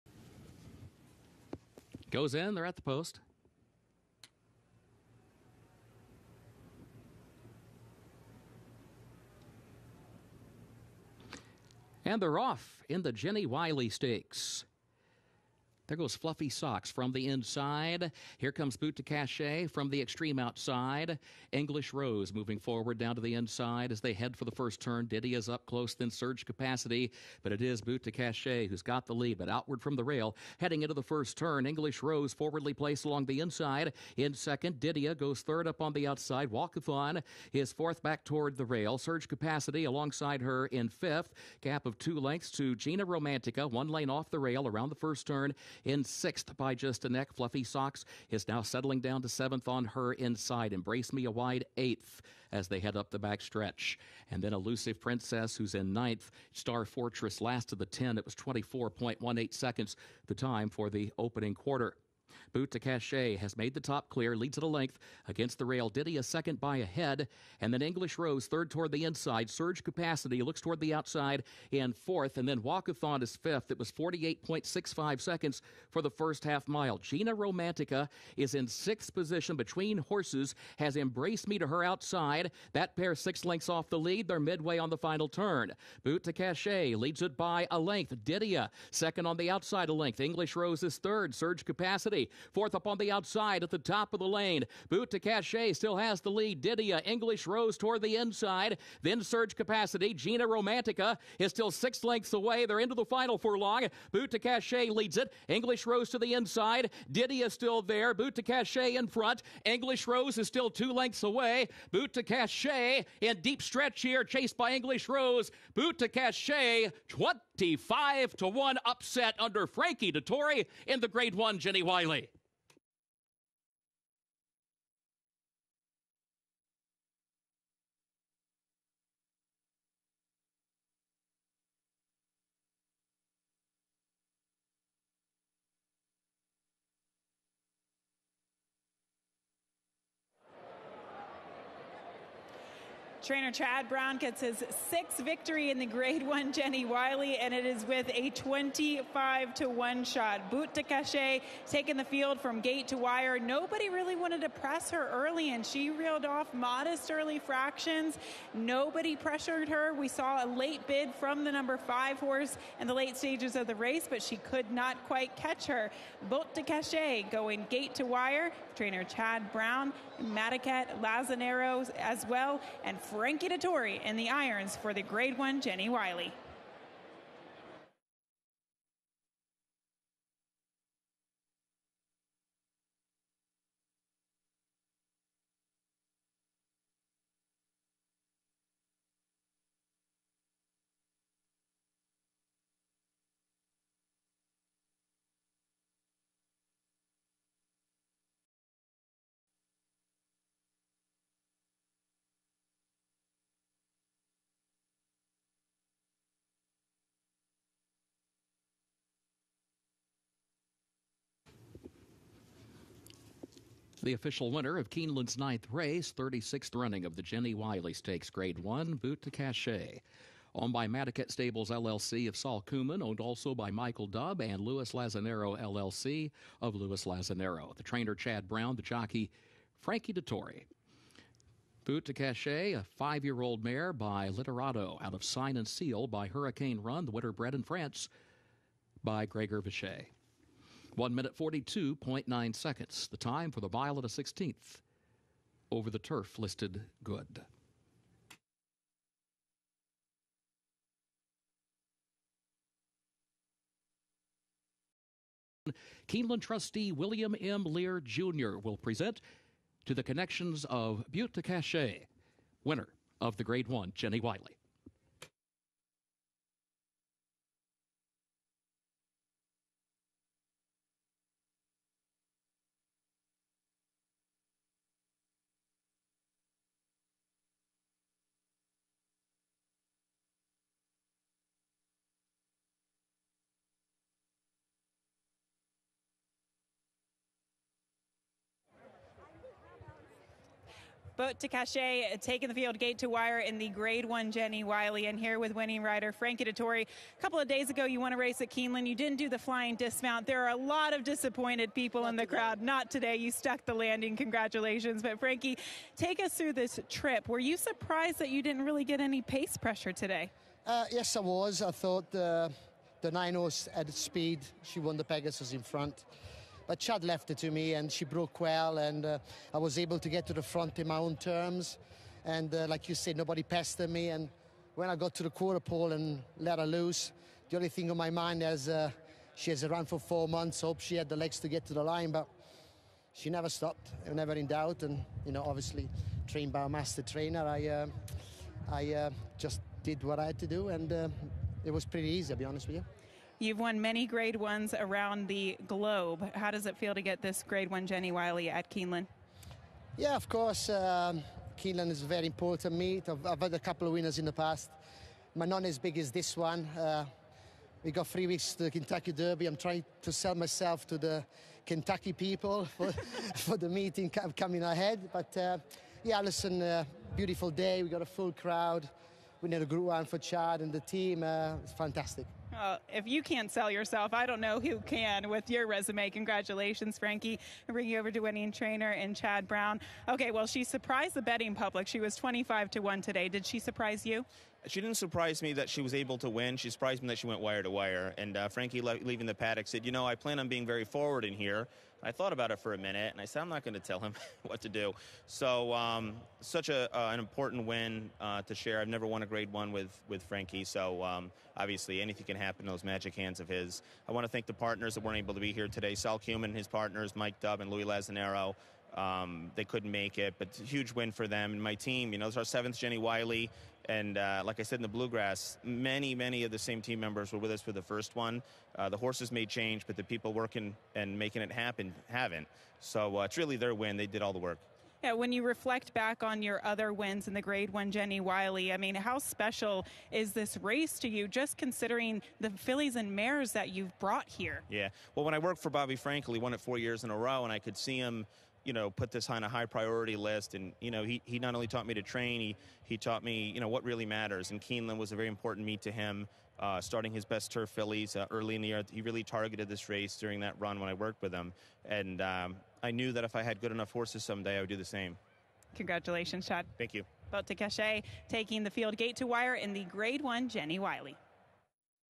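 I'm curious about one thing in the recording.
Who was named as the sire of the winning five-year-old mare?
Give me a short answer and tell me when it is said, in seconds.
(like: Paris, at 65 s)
Literato, at 234 s.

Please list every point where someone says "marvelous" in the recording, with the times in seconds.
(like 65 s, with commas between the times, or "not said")
not said.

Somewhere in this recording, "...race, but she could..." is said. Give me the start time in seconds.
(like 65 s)
163 s.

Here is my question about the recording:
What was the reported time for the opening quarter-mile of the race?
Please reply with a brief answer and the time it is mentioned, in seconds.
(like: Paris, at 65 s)
24.18 seconds, at 58 s.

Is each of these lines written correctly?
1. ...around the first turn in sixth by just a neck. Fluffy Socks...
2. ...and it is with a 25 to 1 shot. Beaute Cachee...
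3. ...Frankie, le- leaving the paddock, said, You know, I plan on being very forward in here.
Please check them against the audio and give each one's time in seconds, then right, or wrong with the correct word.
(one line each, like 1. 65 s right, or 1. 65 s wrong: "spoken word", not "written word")
1. 44 s right
2. 147 s right
3. 388 s right.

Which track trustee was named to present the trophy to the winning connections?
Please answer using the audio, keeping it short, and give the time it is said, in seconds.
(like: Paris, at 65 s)
William M. Lear Jr., at 256 s.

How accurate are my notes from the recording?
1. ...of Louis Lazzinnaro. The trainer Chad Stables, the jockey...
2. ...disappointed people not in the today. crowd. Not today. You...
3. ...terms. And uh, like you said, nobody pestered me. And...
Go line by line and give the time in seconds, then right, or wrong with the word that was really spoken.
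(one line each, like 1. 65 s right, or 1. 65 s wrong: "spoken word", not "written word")
1. 226 s wrong: "Brown", not "Stables"
2. 301 s right
3. 321 s right.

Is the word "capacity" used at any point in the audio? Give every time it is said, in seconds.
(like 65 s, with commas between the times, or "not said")
26 s, 39 s, 69 s, 91 s, 99 s.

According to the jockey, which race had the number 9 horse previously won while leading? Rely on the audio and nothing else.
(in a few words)
the Pegasus.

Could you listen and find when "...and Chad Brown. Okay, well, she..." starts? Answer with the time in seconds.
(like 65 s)
378 s.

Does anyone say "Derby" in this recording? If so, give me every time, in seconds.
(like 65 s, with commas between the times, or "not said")
359 s.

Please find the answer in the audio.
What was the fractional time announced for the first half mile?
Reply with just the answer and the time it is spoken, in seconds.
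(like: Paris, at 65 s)
48.65 seconds, at 73 s.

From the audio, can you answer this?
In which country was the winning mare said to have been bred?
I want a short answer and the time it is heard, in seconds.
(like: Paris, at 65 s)
France, at 237 s.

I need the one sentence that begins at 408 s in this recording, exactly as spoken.
Um, they couldn't make it, but huge win for them and my team.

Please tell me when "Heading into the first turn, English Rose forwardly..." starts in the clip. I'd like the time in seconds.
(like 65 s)
30 s.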